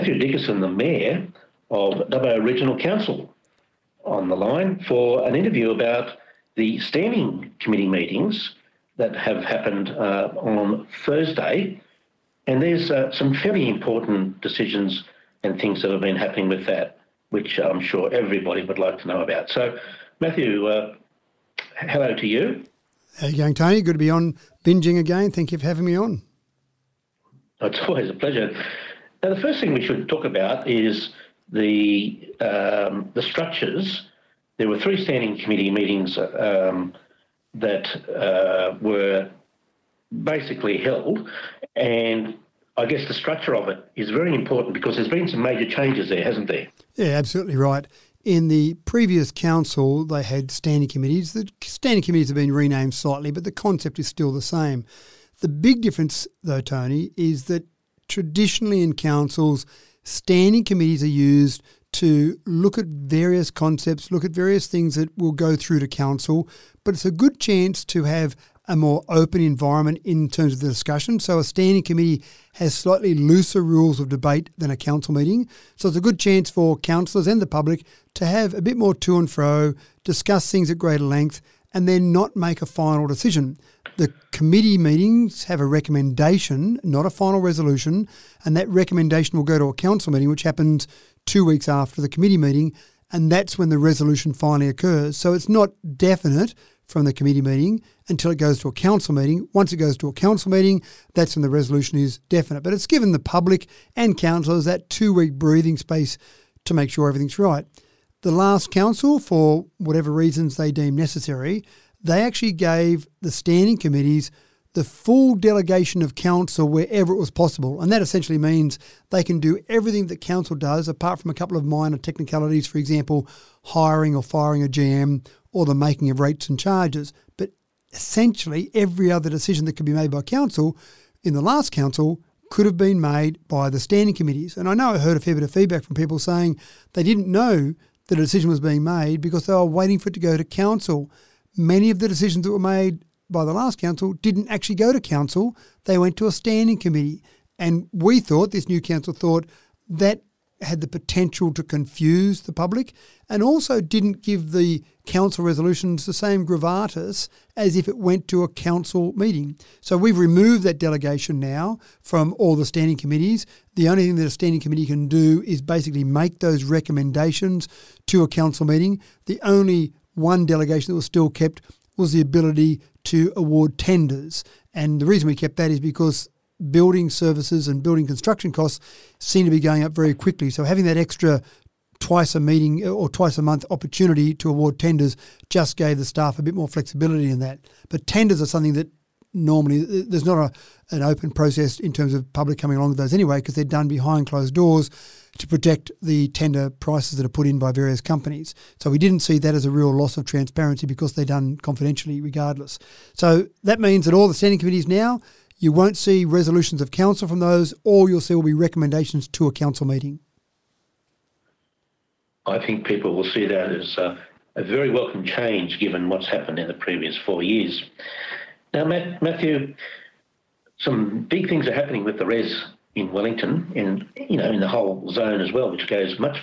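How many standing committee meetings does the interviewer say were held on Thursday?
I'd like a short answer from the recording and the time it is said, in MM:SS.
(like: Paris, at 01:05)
3, at 00:34.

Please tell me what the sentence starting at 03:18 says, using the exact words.
So we didn't see that as a real loss of transparency because they're done confidentially regardless.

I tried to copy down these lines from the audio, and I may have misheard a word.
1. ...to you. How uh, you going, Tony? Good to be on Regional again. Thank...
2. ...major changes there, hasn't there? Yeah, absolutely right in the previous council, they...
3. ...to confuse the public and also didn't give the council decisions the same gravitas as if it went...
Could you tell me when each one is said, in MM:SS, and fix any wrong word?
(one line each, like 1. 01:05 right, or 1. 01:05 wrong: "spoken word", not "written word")
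1. 00:22 wrong: "Binjang", not "Regional"
2. 00:45 right
3. 02:31 wrong: "resolutions", not "decisions".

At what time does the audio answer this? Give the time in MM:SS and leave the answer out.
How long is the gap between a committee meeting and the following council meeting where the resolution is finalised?
01:31.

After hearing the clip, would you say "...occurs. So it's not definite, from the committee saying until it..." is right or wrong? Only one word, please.
wrong.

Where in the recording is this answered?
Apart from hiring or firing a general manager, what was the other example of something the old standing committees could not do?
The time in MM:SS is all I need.
02:05.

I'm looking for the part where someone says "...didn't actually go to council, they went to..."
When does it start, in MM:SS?
02:24.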